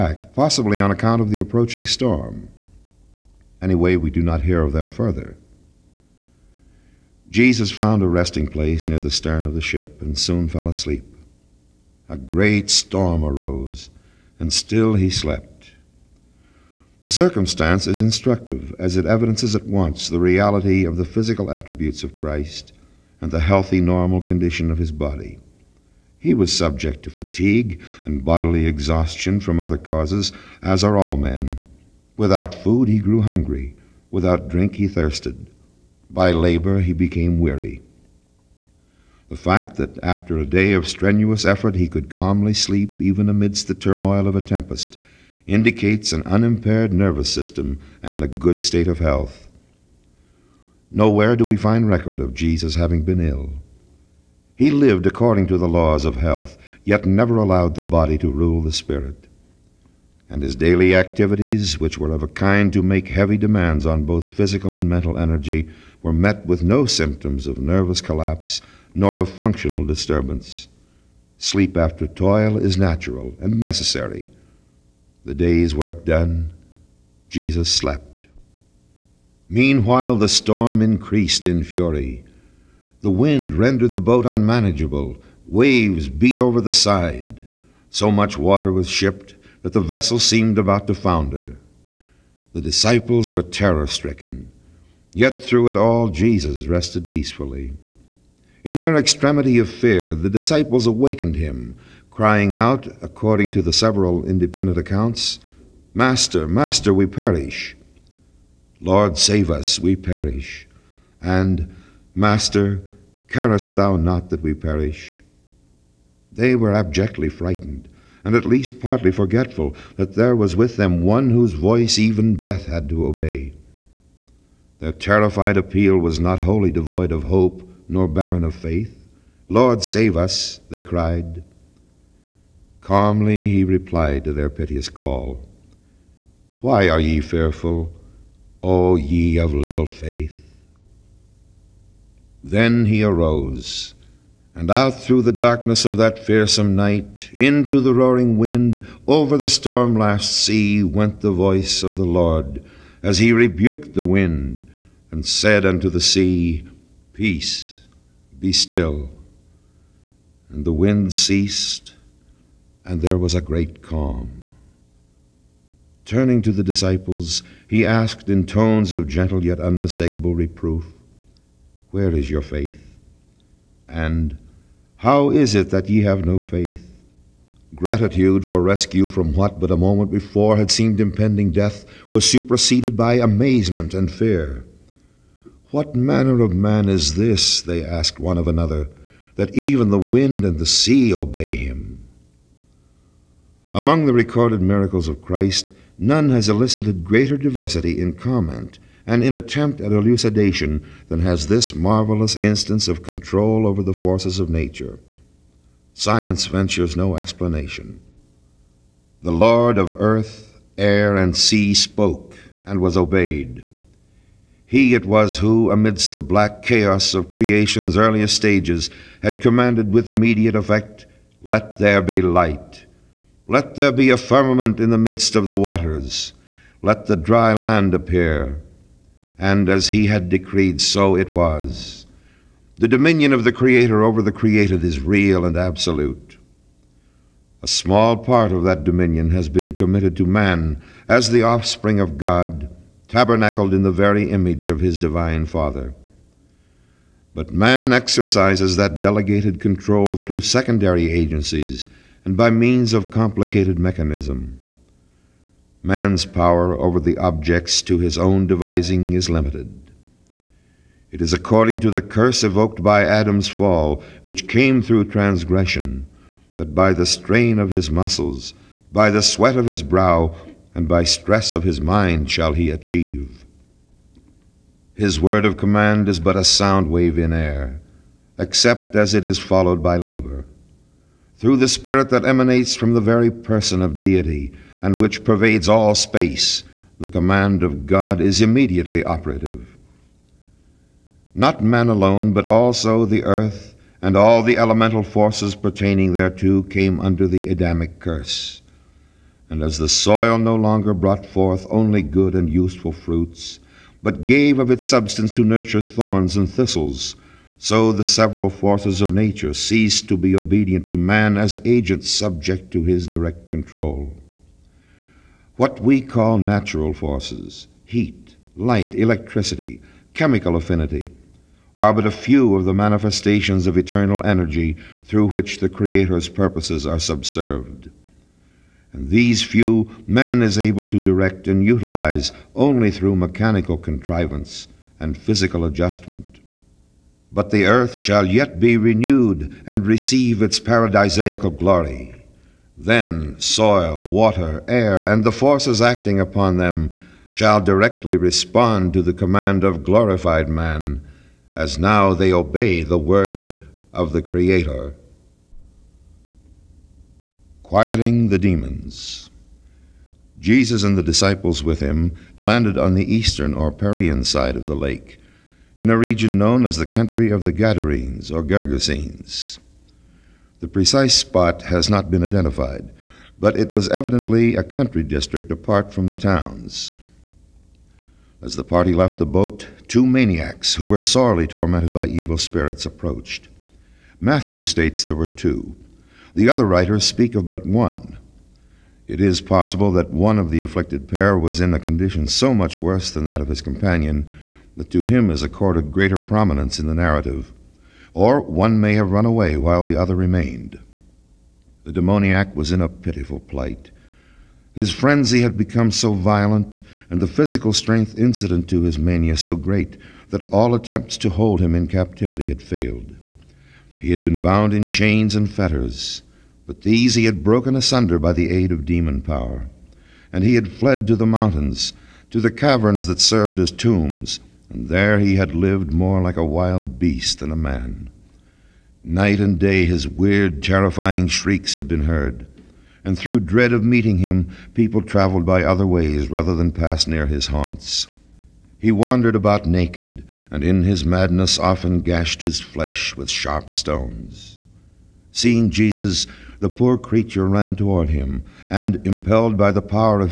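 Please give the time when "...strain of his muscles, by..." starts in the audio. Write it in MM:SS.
04:27.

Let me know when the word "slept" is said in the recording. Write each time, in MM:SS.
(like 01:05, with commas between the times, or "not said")
00:15, 01:17.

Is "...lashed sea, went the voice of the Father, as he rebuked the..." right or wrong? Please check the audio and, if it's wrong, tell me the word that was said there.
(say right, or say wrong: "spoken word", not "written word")
wrong: "Lord", not "Father".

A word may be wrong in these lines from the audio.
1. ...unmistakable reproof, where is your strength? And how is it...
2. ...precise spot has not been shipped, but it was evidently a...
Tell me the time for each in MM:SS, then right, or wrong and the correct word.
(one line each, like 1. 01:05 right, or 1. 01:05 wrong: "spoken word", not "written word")
1. 02:49 wrong: "faith", not "strength"
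2. 06:10 wrong: "identified", not "shipped".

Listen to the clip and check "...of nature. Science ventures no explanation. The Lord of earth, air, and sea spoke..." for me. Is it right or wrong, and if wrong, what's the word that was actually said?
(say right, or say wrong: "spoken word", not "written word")
right.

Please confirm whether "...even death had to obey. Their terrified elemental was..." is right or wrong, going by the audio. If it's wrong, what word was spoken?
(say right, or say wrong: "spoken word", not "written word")
wrong: "appeal", not "elemental".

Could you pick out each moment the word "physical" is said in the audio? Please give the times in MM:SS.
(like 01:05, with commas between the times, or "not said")
00:21, 01:04, 05:35, 06:47.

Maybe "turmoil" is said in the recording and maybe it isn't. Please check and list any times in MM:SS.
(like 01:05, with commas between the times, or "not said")
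00:43.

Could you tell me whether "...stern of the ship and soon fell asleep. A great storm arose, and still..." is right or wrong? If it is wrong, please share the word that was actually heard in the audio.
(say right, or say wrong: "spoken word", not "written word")
right.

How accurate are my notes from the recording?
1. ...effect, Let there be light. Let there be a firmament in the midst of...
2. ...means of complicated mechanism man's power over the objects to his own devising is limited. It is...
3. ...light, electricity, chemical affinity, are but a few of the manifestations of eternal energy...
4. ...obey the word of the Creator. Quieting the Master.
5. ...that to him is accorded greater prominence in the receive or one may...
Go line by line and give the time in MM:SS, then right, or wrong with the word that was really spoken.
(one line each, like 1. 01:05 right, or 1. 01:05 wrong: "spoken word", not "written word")
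1. 03:40 right
2. 04:12 right
3. 05:18 right
4. 05:52 wrong: "Demons", not "Master"
5. 06:34 wrong: "narrative", not "receive".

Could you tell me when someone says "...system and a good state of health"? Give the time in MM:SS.
00:47.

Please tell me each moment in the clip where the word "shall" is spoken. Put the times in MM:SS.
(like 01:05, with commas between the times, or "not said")
04:32, 05:37, 05:47.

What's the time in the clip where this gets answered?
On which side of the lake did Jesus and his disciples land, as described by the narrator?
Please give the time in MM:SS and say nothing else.
06:03.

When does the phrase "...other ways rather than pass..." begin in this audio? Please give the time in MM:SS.
07:15.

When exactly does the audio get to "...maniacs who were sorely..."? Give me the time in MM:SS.
06:20.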